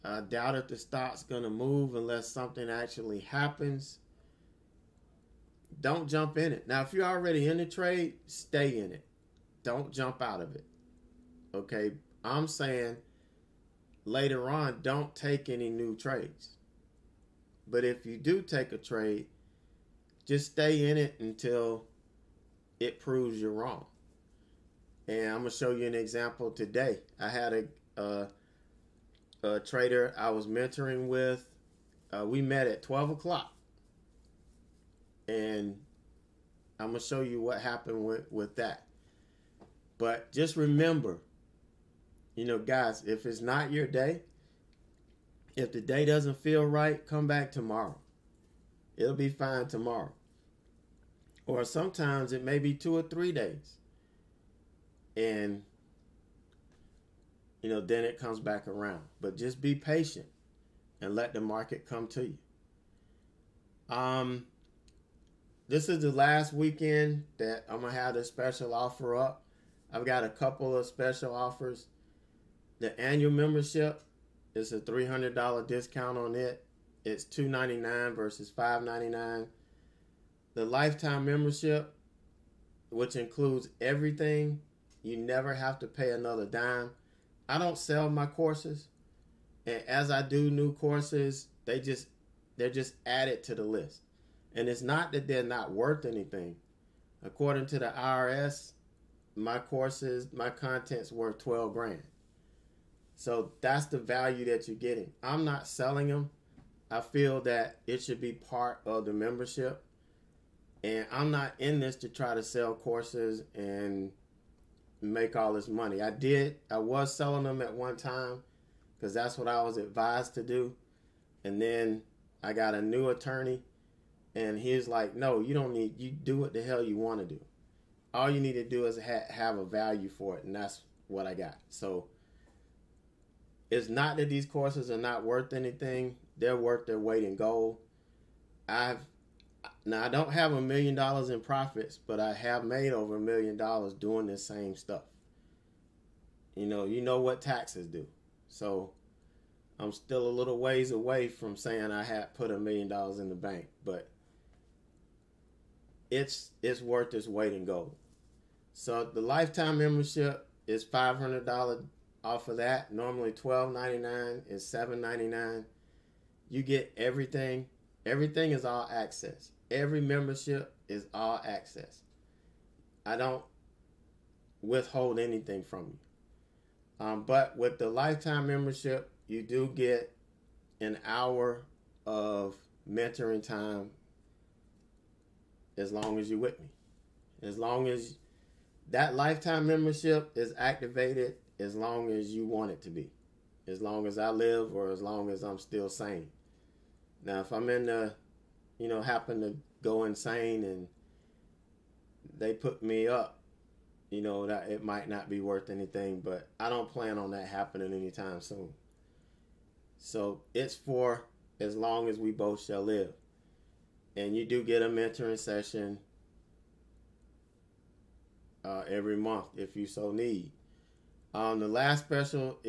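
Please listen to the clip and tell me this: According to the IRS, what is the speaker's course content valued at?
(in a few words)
12 grand.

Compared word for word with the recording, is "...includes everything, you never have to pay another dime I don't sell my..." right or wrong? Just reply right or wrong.
right.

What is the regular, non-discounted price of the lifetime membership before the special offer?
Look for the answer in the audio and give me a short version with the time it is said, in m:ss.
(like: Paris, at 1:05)
$1,299, at 2:43.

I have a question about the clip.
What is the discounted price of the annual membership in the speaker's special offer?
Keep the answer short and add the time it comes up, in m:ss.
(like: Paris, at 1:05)
$299, at 1:17.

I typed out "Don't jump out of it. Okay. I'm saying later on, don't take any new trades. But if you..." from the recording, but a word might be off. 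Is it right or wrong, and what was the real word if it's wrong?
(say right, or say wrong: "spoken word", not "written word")
right.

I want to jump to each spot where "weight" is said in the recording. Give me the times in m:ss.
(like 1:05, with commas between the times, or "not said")
2:16, 2:37.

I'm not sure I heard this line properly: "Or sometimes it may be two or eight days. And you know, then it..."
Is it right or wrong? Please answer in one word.
wrong.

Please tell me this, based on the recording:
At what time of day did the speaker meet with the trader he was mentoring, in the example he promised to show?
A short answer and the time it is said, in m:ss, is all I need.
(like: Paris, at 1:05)
12 o'clock, at 0:32.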